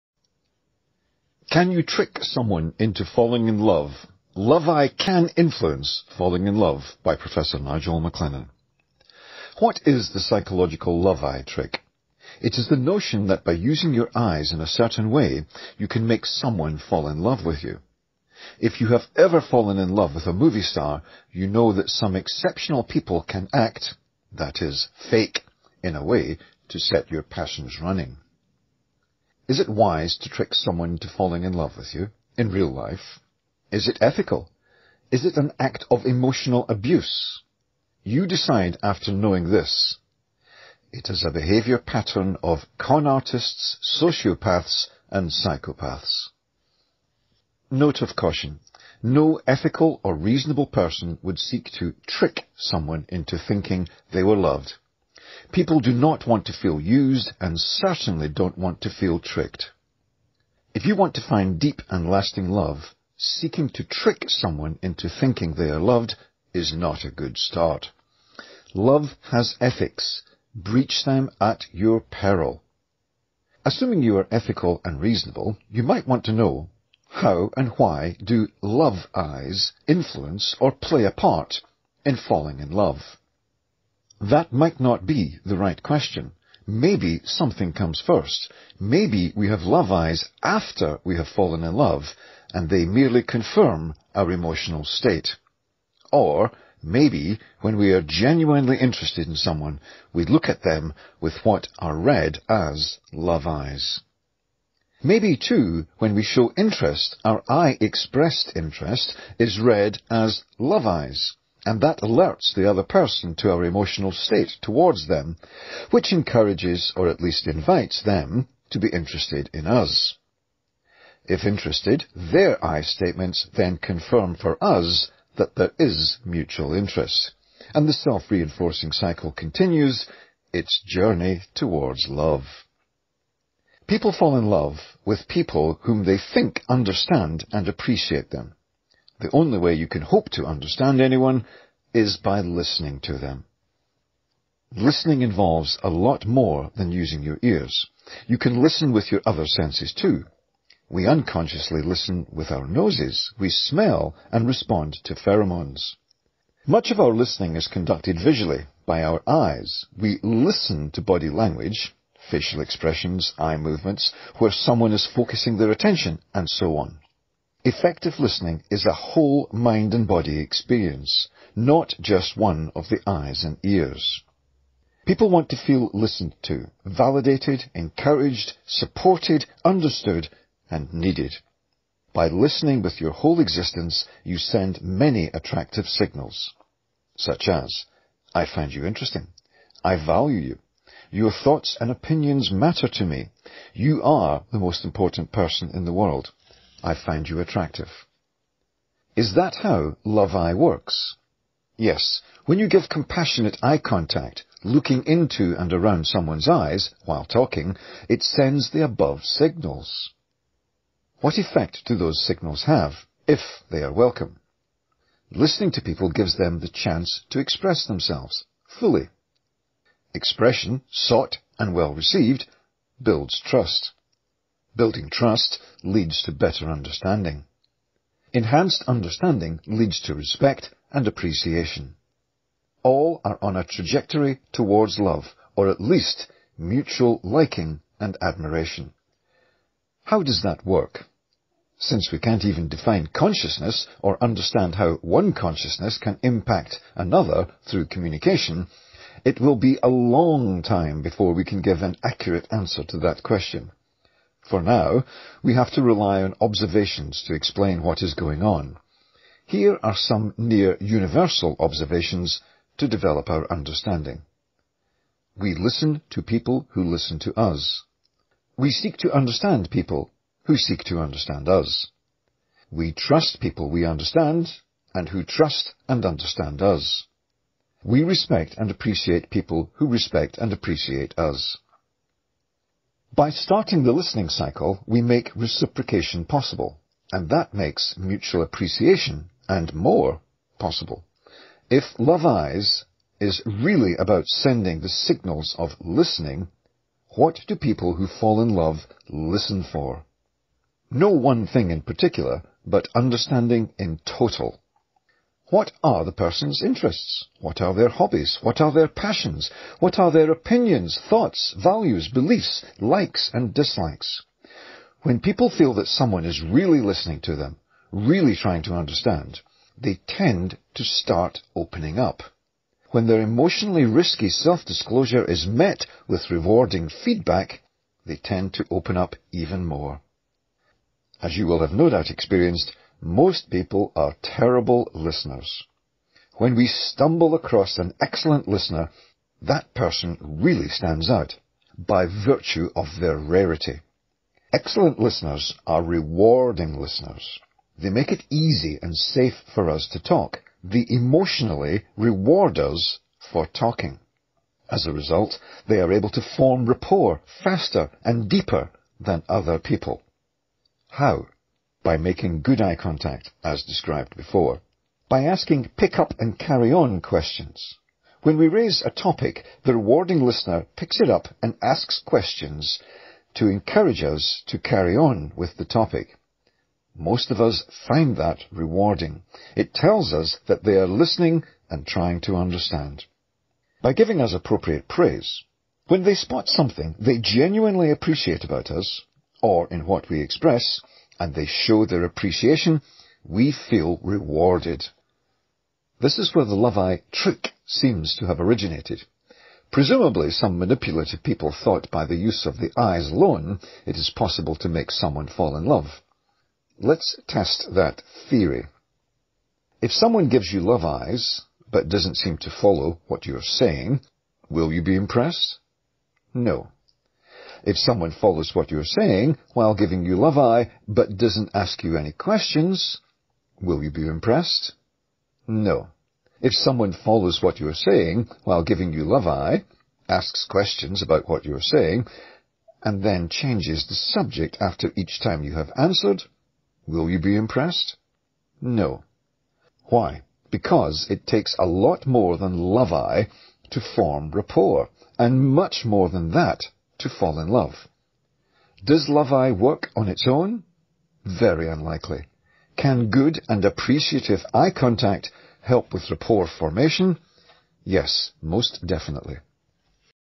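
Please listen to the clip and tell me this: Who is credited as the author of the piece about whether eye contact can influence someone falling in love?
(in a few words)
Professor Nigel MacLennan.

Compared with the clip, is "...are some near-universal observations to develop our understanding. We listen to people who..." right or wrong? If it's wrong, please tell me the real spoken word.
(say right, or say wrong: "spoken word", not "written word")
right.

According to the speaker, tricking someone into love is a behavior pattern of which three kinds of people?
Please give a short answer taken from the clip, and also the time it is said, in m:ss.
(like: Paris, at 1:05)
con artists, sociopaths, and psychopaths, at 0:42.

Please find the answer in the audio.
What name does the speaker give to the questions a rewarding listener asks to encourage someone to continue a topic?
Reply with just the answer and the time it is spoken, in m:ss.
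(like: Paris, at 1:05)
pick up and carry on questions, at 6:05.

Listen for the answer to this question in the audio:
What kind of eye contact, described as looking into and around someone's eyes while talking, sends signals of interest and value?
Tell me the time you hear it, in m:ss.
3:22.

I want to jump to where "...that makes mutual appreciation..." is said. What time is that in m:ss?
4:47.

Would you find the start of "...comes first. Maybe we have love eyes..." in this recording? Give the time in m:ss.
1:27.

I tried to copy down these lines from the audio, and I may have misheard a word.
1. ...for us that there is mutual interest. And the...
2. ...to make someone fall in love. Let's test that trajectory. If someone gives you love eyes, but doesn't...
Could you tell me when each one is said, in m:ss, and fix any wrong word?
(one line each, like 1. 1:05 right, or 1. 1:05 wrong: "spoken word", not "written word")
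1. 2:04 right
2. 6:44 wrong: "theory", not "trajectory".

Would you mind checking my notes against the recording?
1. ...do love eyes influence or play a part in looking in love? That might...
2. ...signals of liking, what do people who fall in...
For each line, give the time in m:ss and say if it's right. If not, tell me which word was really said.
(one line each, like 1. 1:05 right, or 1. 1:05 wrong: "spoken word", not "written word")
1. 1:18 wrong: "falling", not "looking"
2. 4:54 wrong: "listening", not "liking".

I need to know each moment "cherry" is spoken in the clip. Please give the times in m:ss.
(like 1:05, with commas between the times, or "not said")
not said.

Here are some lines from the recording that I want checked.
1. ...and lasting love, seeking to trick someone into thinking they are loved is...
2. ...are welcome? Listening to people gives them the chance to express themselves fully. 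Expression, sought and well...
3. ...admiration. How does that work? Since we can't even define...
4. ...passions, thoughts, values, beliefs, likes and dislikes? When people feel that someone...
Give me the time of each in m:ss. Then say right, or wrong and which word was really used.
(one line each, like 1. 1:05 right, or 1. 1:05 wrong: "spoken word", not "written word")
1. 1:01 right
2. 3:33 right
3. 3:58 right
4. 5:10 wrong: "opinions", not "passions".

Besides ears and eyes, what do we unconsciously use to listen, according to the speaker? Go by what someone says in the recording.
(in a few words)
noses.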